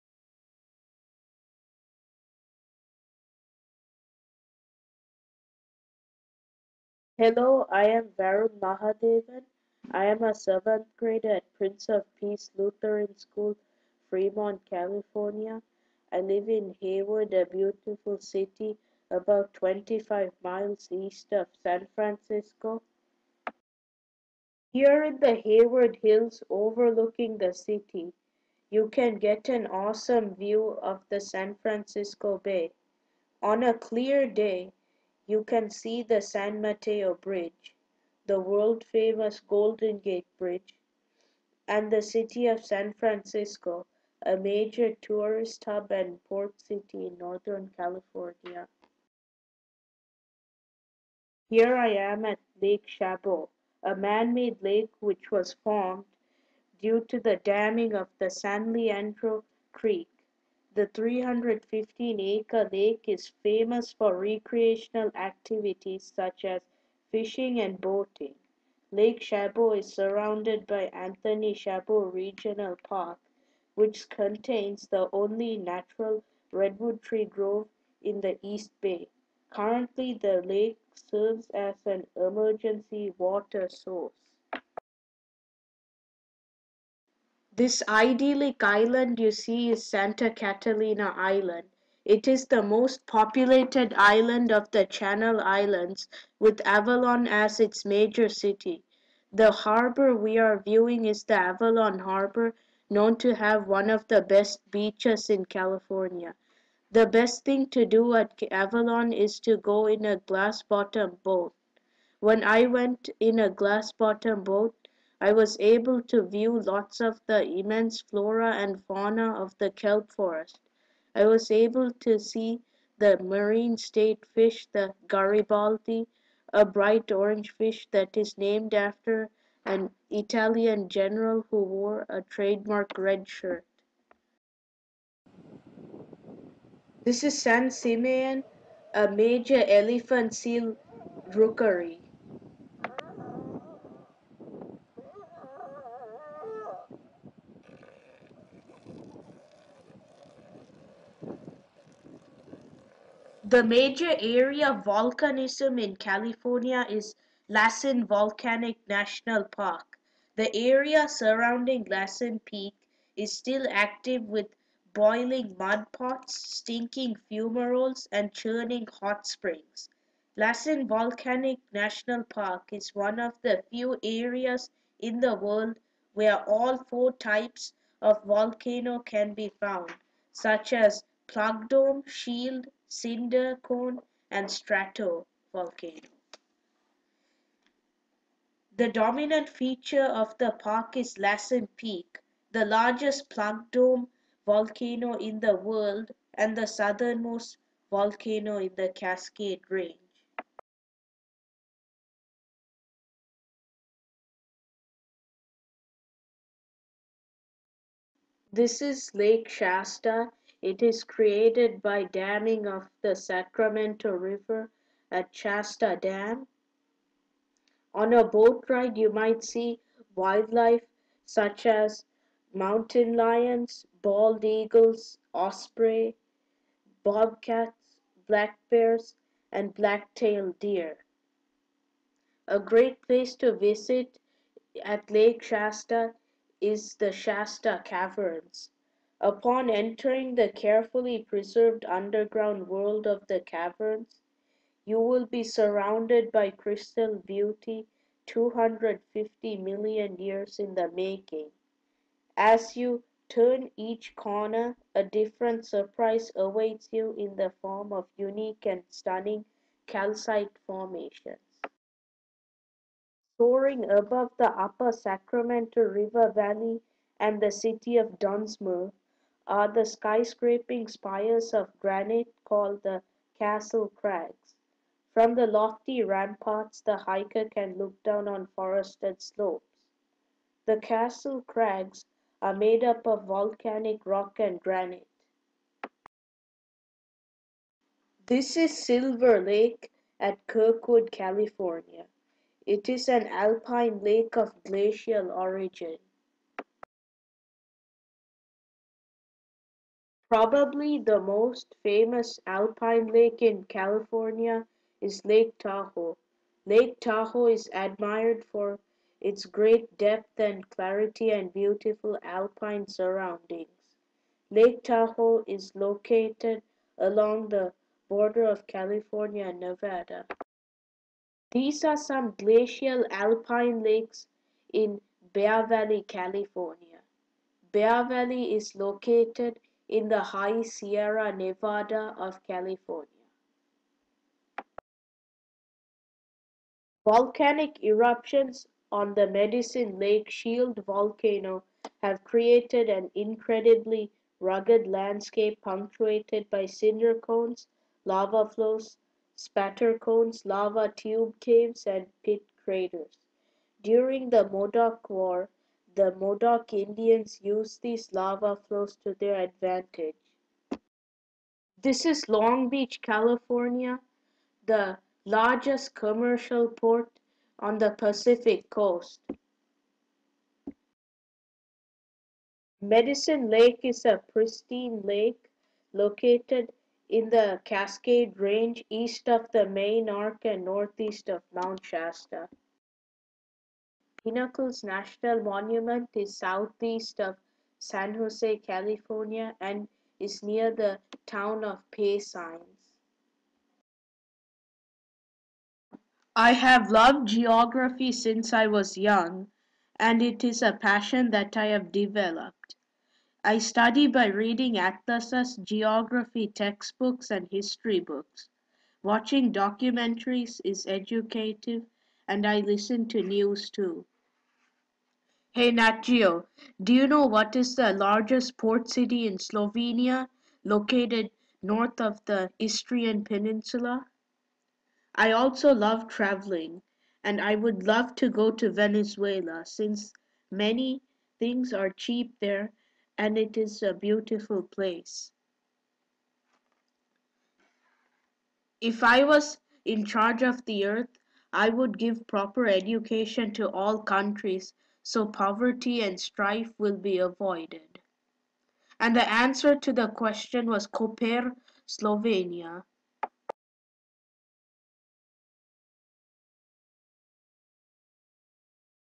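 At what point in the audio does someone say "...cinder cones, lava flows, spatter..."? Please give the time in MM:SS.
05:46.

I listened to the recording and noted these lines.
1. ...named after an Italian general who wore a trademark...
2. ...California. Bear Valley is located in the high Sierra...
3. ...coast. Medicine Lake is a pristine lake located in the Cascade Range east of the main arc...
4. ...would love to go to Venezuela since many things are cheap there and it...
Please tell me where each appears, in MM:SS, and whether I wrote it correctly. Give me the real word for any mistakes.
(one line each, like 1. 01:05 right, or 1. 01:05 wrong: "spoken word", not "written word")
1. 02:08 right
2. 05:26 right
3. 06:08 right
4. 07:07 right.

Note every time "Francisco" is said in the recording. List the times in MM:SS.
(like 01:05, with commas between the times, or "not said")
00:21, 00:31, 00:42.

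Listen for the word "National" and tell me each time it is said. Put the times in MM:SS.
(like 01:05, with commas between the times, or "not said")
02:38, 02:51, 06:24.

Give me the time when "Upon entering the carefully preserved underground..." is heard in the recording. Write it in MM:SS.
03:59.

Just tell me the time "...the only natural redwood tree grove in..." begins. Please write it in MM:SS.
01:14.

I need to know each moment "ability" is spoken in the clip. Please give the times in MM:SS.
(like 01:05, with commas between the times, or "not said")
not said.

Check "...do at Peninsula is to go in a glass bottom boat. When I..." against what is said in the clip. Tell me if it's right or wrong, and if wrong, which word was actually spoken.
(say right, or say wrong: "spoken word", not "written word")
wrong: "Avalon", not "Peninsula".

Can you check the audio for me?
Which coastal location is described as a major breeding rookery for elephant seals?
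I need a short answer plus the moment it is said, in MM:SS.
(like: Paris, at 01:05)
San Simeon, at 02:17.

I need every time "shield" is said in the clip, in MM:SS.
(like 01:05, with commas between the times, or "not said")
03:02, 05:40.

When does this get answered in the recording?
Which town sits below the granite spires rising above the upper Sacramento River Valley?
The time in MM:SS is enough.
04:28.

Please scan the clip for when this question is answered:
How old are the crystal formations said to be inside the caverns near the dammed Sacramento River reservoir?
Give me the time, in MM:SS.
04:08.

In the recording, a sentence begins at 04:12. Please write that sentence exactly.
As you turn each corner, a different surprise awaits you in the form of unique and stunning calcite formations.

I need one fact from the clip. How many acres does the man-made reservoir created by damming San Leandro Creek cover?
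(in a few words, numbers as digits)
315.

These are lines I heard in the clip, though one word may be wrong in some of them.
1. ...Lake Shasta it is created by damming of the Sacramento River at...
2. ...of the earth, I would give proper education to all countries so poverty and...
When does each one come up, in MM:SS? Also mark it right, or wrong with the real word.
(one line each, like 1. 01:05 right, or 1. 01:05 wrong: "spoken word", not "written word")
1. 03:29 right
2. 07:20 right.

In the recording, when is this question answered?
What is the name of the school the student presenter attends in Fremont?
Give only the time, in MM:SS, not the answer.
00:11.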